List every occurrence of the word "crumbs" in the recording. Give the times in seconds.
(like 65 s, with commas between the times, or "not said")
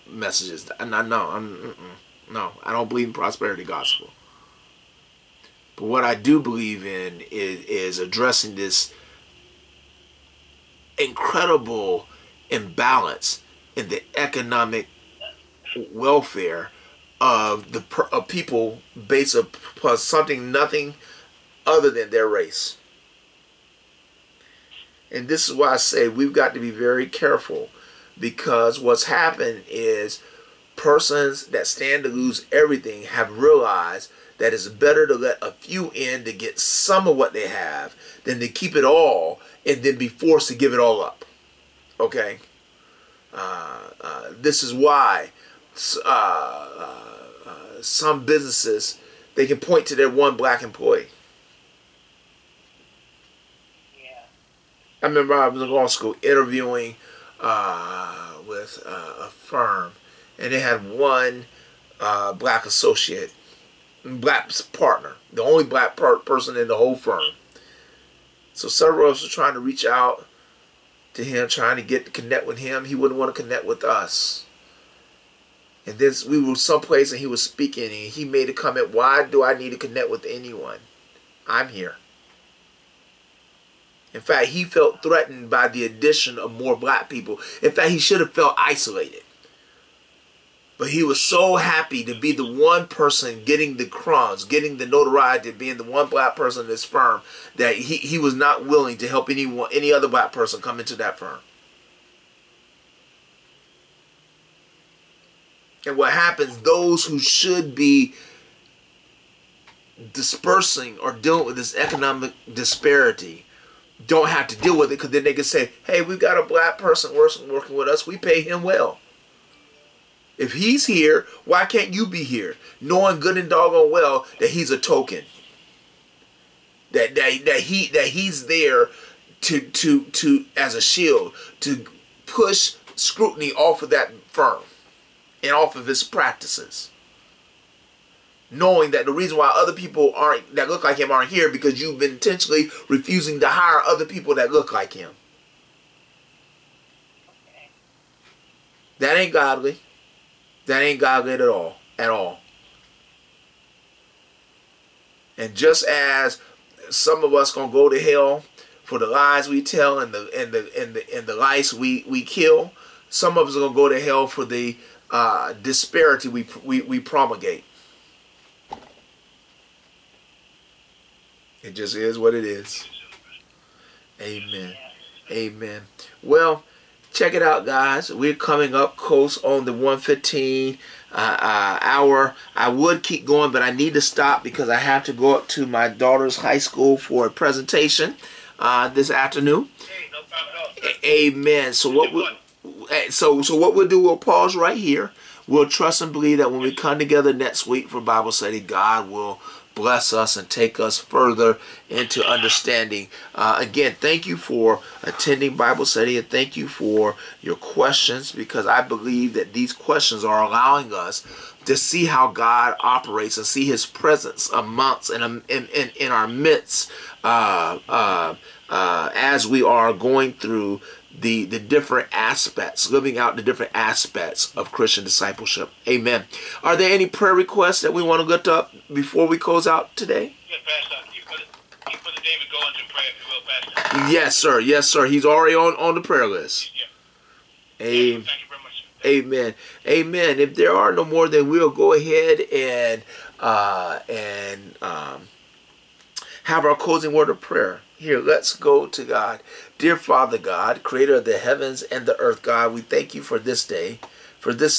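93 s.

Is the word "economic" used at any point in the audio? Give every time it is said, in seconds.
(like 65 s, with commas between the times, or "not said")
14 s, 111 s.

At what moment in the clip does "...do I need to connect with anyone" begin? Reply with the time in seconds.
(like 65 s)
79 s.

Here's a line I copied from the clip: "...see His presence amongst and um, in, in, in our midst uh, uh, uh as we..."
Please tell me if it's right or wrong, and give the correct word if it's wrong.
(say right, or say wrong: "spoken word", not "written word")
right.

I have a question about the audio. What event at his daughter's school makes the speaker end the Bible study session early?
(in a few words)
A presentation.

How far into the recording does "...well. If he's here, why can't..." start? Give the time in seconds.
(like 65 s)
118 s.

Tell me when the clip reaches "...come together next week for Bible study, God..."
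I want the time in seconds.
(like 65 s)
196 s.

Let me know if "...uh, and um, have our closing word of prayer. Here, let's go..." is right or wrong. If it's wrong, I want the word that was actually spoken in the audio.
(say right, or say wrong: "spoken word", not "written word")
right.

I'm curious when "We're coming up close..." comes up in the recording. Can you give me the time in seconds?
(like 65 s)
178 s.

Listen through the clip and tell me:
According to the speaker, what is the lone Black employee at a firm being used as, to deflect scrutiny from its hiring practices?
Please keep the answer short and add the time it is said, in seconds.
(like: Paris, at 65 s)
A shield, at 130 s.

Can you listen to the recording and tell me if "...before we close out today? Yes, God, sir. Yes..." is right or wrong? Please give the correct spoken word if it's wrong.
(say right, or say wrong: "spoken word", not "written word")
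wrong: "Yes", not "God".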